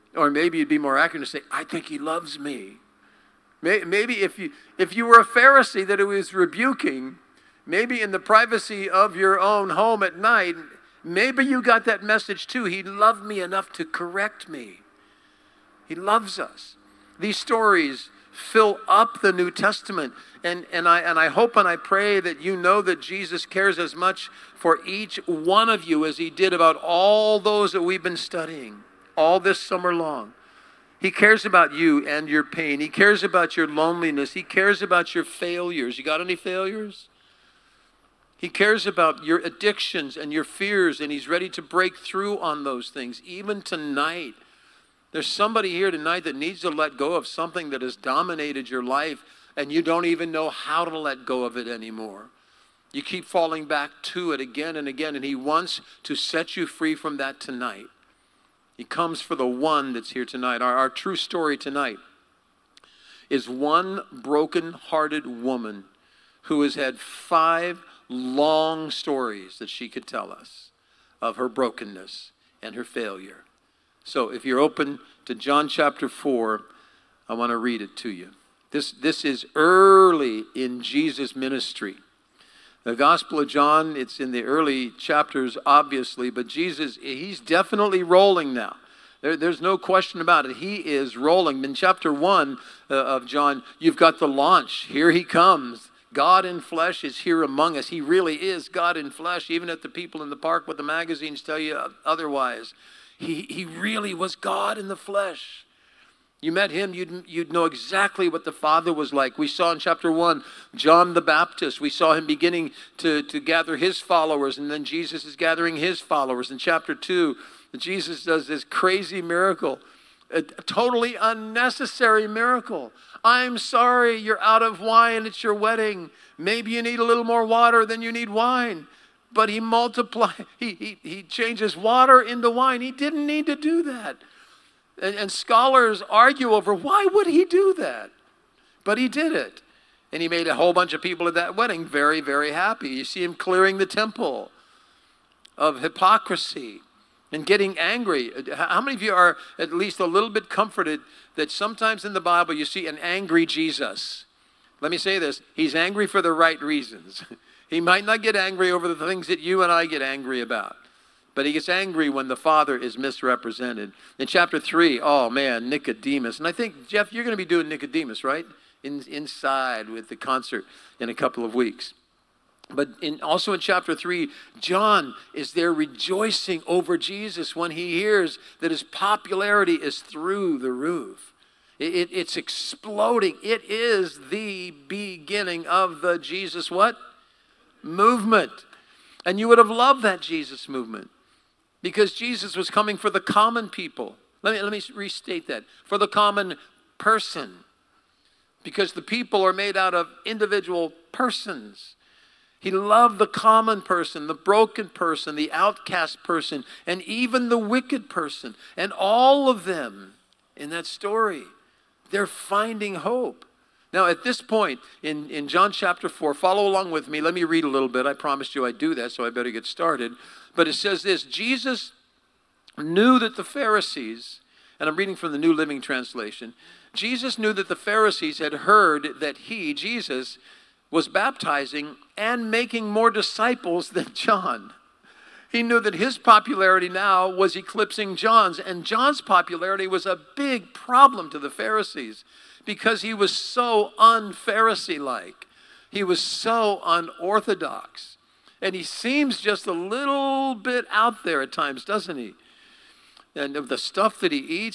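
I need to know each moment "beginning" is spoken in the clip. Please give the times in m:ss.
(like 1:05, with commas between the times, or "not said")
1:52, 3:04.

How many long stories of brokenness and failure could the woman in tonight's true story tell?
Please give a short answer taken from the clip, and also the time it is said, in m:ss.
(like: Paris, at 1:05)
5, at 1:06.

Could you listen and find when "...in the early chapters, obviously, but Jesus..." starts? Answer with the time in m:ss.
1:24.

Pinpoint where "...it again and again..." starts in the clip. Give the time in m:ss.
0:54.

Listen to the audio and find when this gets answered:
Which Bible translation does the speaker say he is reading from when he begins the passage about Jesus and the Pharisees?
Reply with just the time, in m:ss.
3:45.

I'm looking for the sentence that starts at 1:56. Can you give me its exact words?
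In chapter 2, Jesus does this crazy miracle, a totally unnecessary miracle.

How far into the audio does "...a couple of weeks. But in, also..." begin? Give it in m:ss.
2:51.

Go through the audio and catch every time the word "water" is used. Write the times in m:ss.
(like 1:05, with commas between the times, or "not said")
2:07, 2:11.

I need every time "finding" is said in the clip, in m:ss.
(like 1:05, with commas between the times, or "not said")
3:32.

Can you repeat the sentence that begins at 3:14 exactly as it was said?
Let me, let me restate that for the common person because the people are made out of individual persons.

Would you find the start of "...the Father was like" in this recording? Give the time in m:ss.
1:48.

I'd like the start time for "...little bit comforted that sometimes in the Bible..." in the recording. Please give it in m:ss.
2:30.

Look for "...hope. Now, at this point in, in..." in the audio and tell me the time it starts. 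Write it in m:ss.
3:32.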